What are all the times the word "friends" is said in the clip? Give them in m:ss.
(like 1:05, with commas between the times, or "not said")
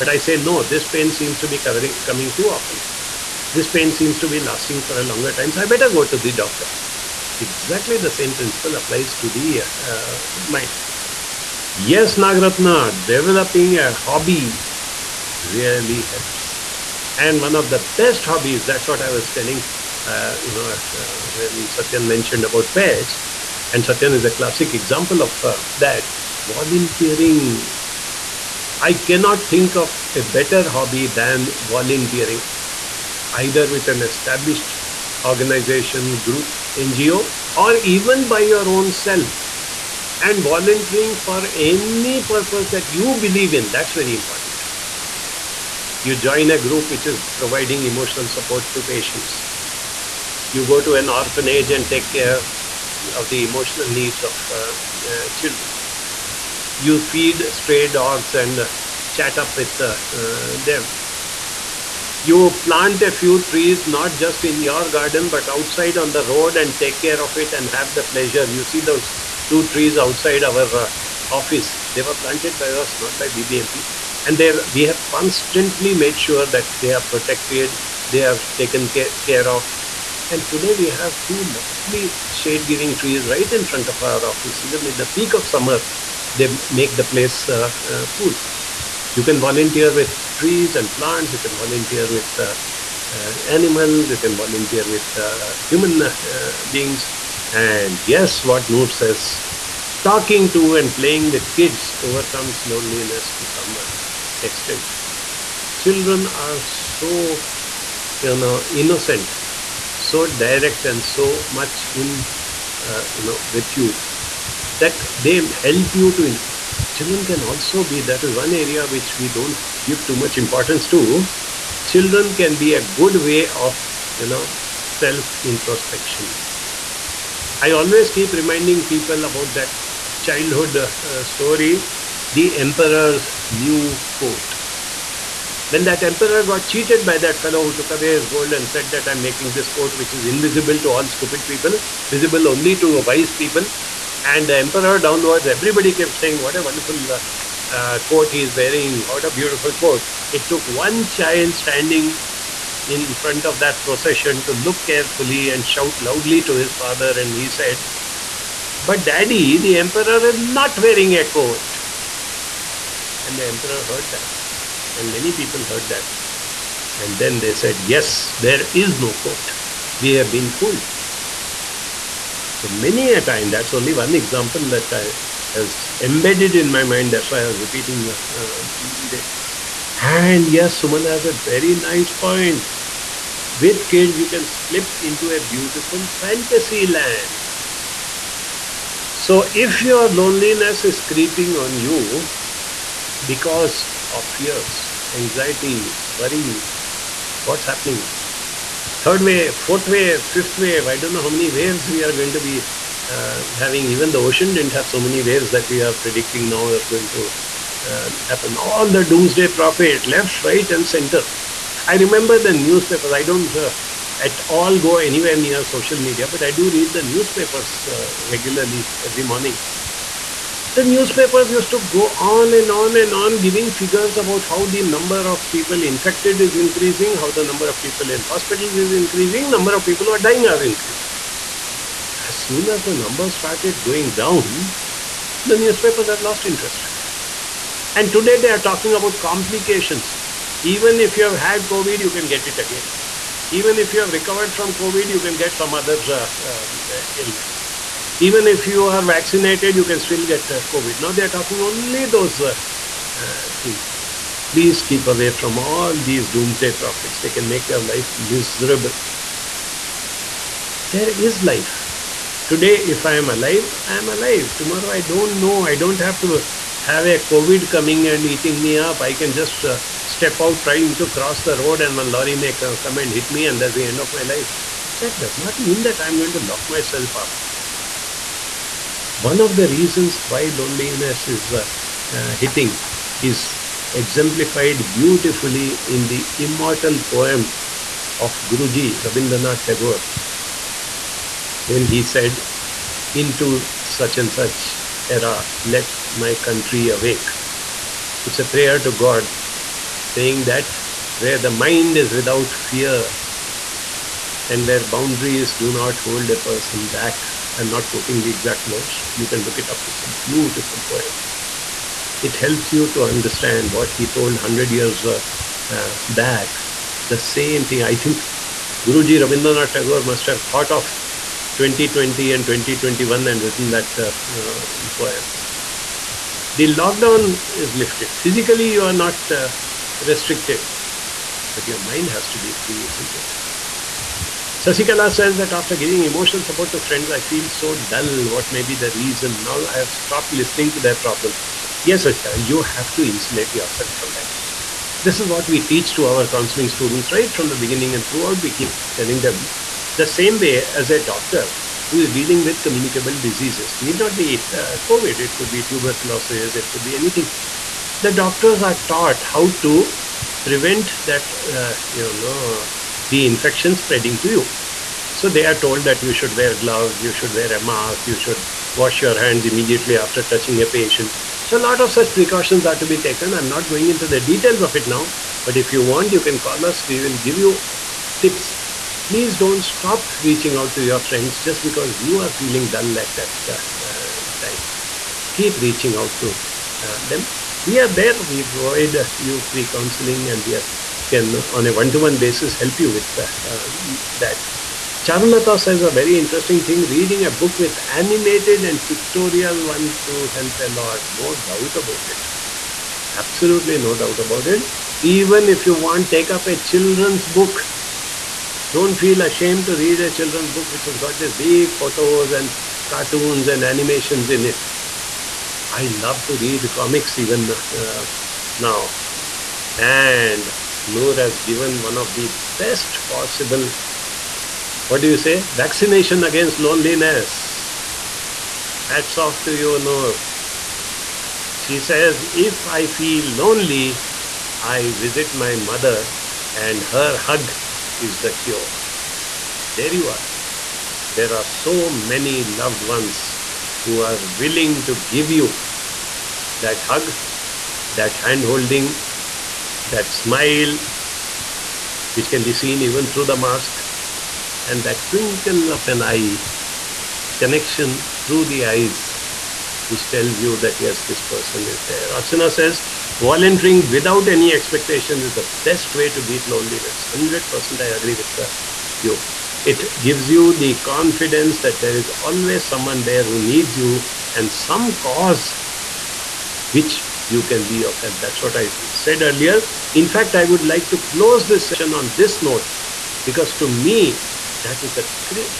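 5:36, 6:20.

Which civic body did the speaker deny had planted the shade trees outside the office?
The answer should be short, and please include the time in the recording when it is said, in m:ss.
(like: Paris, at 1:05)
BBMP, at 1:13.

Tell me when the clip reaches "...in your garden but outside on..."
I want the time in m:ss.
1:04.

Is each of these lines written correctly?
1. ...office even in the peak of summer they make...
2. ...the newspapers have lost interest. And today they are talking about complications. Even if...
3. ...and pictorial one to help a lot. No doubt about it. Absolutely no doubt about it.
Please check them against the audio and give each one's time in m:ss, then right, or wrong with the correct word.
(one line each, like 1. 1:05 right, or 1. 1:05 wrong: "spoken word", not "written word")
1. 1:24 right
2. 3:55 right
3. 6:38 right.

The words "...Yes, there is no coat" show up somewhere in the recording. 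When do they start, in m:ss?
2:47.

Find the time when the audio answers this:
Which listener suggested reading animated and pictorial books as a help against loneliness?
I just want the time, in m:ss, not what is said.
6:35.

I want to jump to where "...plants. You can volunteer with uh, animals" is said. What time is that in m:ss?
1:30.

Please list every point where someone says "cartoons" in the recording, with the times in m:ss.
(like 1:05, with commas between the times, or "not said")
6:52.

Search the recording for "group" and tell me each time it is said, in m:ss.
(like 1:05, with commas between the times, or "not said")
0:36, 0:46.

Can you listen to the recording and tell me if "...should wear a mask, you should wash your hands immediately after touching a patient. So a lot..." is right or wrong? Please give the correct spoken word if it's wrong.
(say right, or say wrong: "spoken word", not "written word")
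right.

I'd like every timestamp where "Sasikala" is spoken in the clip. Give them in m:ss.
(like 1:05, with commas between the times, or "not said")
5:34, 5:42.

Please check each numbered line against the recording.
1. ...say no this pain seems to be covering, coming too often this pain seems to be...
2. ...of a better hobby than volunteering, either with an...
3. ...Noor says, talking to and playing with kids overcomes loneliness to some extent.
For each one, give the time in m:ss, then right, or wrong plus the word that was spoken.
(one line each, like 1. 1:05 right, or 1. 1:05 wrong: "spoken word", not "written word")
1. 0:00 right
2. 0:29 right
3. 1:38 right.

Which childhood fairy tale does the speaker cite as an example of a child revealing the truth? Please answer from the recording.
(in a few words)
The Emperor's New Coat.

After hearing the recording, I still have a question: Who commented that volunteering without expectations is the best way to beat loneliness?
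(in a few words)
Archana.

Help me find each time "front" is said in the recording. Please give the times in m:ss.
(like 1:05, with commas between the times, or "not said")
1:23, 2:33.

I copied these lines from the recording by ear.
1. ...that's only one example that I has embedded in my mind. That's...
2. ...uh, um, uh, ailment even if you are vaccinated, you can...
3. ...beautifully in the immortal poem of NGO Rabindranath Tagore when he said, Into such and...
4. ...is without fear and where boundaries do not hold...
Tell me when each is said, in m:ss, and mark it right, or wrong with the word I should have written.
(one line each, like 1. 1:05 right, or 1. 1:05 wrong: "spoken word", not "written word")
1. 2:53 right
2. 4:06 right
3. 4:44 wrong: "Guruji", not "NGO"
4. 5:01 right.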